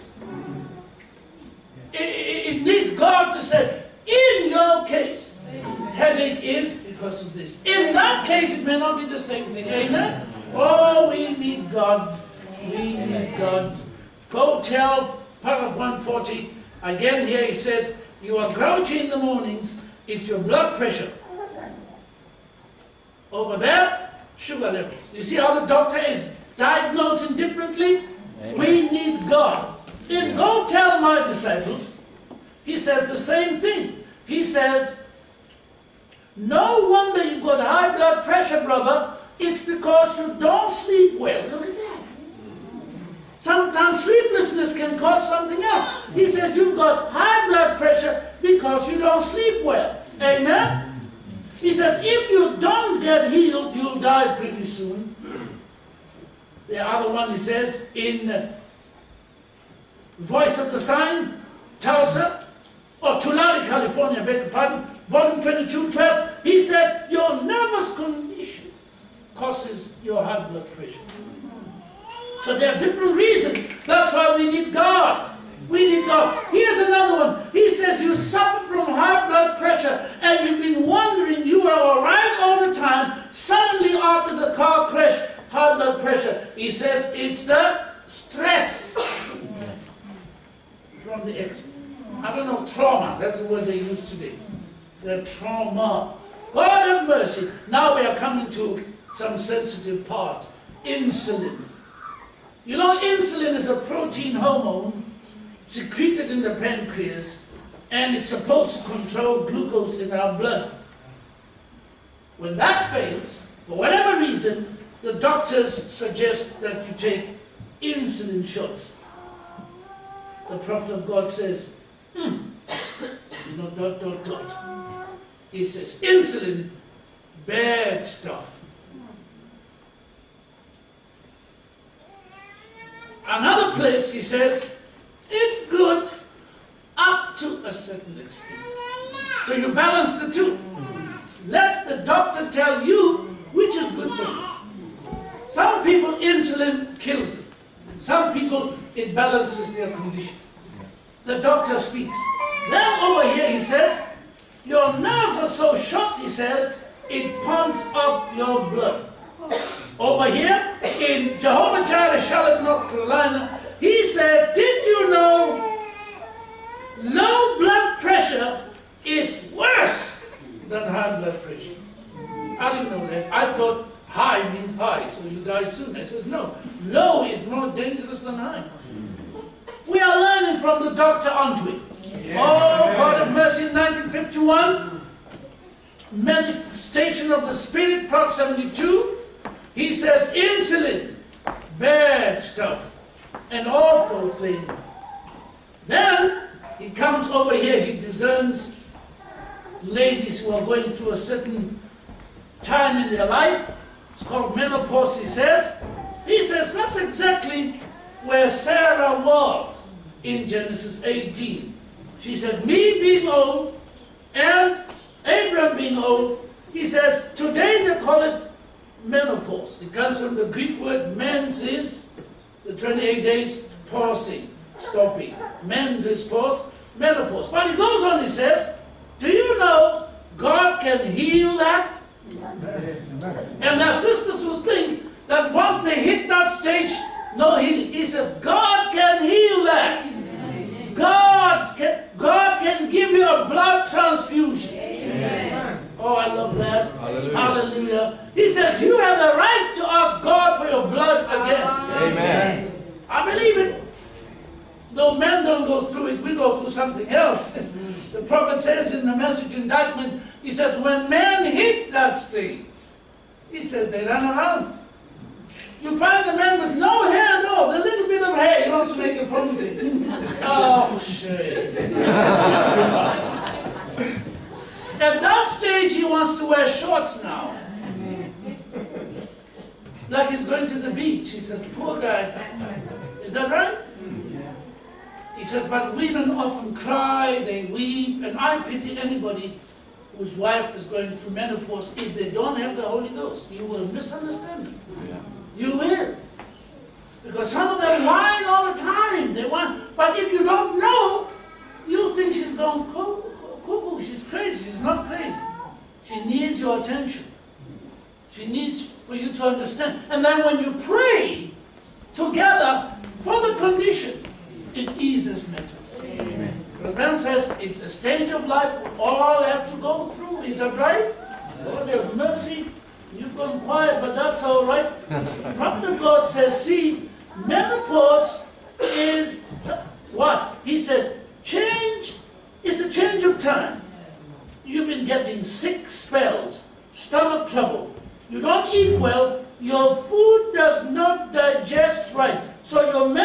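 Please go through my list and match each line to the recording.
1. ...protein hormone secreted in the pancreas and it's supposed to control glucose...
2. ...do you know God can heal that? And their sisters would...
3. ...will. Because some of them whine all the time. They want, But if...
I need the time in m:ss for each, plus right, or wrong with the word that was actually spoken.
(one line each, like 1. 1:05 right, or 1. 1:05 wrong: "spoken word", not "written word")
1. 1:43 right
2. 3:49 right
3. 4:55 right.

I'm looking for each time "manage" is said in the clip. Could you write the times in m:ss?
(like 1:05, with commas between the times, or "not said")
not said.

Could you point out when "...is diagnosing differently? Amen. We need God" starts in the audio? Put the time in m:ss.
0:25.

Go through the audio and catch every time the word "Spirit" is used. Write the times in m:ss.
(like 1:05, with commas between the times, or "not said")
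3:07.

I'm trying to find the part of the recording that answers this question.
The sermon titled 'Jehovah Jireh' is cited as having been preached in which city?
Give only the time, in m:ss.
2:42.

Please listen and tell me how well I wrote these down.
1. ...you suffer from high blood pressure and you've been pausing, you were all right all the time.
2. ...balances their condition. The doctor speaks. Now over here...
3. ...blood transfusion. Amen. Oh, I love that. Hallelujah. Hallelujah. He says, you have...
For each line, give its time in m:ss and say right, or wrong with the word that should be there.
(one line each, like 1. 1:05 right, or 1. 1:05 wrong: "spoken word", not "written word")
1. 1:18 wrong: "wondering", not "pausing"
2. 2:29 right
3. 4:03 right.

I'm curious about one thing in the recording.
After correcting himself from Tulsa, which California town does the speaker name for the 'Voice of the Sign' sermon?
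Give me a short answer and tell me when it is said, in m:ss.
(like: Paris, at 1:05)
Tulare, at 1:03.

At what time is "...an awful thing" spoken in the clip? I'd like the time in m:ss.
3:13.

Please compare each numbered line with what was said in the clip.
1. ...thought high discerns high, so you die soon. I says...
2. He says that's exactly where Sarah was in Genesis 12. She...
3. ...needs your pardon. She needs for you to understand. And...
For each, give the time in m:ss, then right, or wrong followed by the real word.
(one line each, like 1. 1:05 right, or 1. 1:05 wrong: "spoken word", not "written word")
1. 2:53 wrong: "means", not "discerns"
2. 3:26 wrong: "18", not "12"
3. 5:06 wrong: "attention", not "pardon".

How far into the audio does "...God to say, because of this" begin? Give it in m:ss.
0:02.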